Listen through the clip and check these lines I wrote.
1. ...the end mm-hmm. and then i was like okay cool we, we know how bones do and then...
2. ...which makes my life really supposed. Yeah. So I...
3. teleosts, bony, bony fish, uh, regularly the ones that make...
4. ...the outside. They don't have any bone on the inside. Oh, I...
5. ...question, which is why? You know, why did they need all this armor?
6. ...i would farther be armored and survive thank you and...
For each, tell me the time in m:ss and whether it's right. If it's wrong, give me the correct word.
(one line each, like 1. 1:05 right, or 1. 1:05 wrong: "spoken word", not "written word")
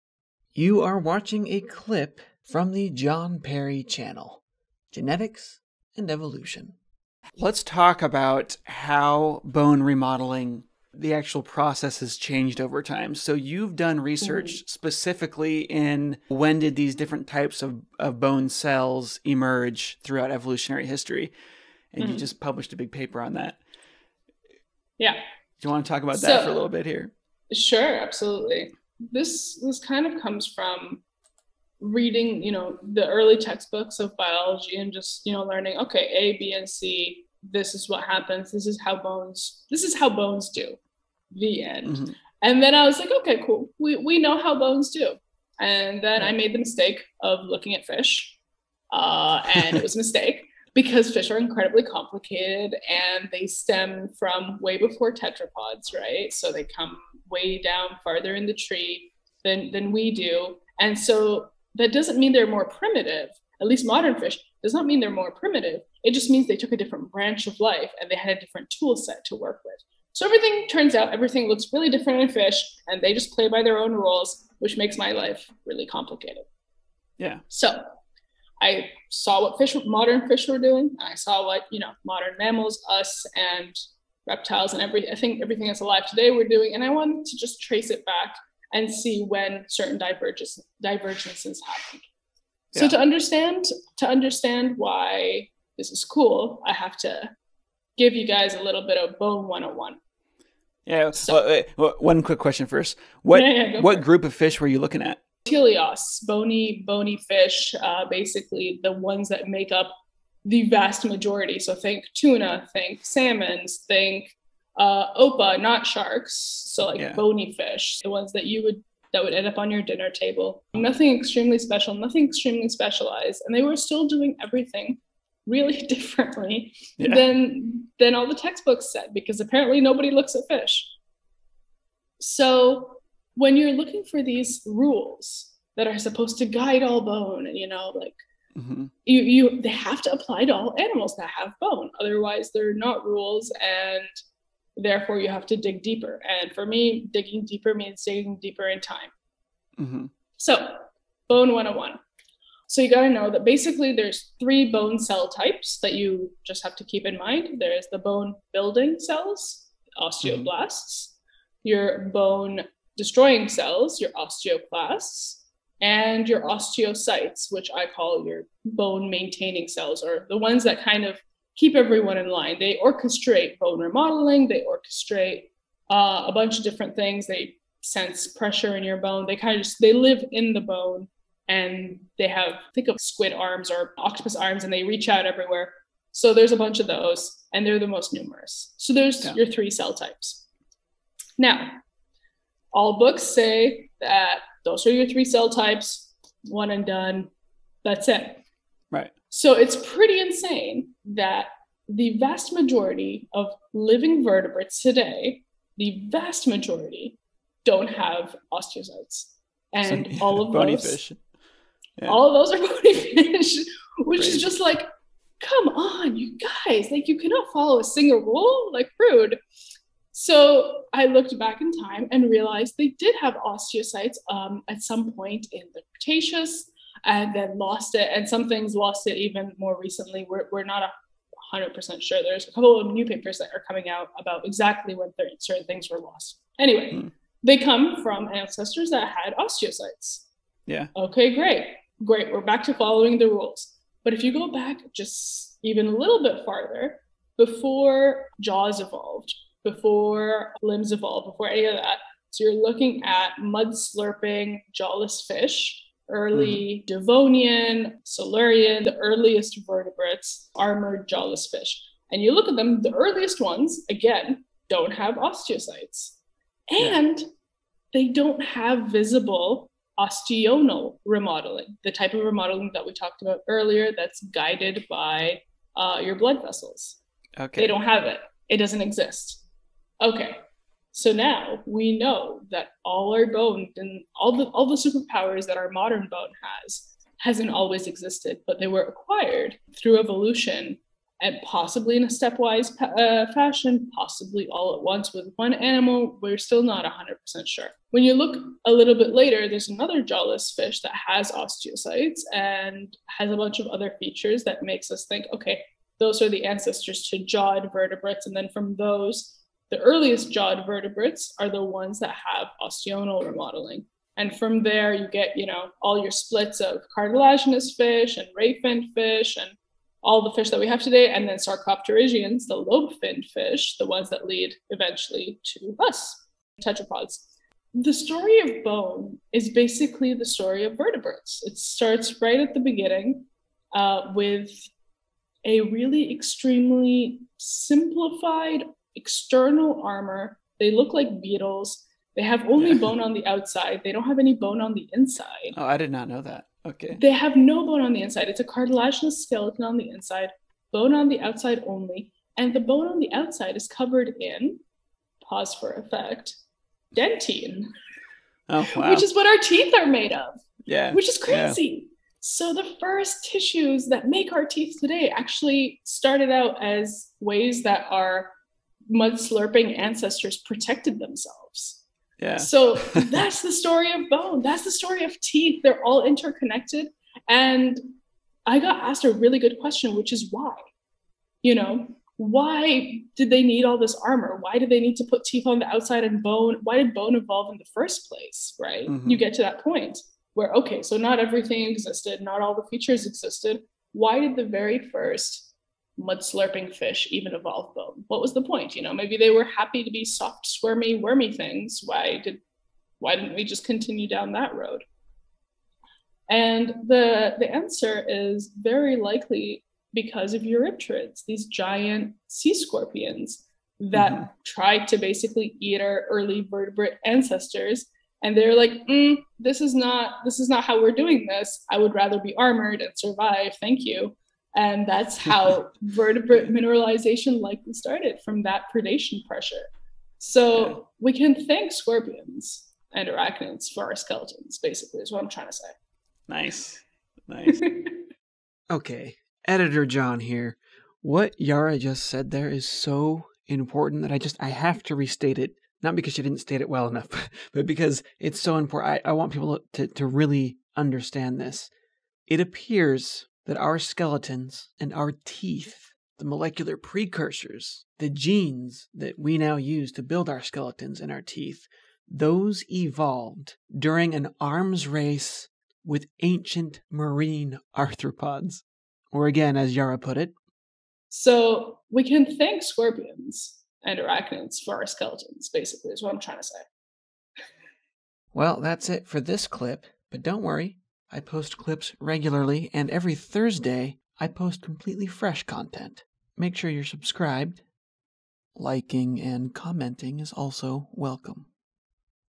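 1. 0:41 right
2. 1:14 wrong: "complicated", not "supposed"
3. 1:45 wrong: "basically", not "regularly"
4. 5:43 right
5. 6:19 right
6. 7:01 wrong: "rather", not "farther".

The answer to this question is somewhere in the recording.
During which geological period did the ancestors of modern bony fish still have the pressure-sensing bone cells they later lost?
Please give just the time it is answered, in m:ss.
3:45.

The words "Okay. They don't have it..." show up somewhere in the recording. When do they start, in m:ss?
4:37.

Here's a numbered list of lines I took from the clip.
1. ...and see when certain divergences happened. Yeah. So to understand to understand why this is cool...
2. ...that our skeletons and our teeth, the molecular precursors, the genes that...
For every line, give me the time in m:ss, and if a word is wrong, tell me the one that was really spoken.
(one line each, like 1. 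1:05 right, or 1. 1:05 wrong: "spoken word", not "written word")
1. 1:28 right
2. 7:33 right.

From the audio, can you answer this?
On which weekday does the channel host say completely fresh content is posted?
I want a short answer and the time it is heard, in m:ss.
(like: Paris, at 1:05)
Thursday, at 8:03.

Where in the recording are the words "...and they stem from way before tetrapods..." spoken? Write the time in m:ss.
0:52.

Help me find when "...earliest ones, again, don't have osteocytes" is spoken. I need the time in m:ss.
4:22.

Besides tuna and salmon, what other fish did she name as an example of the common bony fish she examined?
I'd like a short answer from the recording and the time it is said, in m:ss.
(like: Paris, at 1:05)
Opah, at 1:55.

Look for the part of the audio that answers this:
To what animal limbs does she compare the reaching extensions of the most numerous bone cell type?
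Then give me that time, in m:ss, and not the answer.
3:03.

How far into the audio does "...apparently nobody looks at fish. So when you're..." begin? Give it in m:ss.
2:09.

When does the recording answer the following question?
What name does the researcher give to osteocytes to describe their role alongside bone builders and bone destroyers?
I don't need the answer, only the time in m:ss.
2:48.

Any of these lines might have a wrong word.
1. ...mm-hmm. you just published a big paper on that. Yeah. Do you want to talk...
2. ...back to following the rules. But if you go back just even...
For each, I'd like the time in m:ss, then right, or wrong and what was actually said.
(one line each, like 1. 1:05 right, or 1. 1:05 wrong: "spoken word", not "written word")
1. 0:22 right
2. 4:02 right.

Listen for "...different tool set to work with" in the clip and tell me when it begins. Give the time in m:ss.
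1:08.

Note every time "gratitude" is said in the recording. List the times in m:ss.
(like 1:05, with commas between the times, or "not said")
not said.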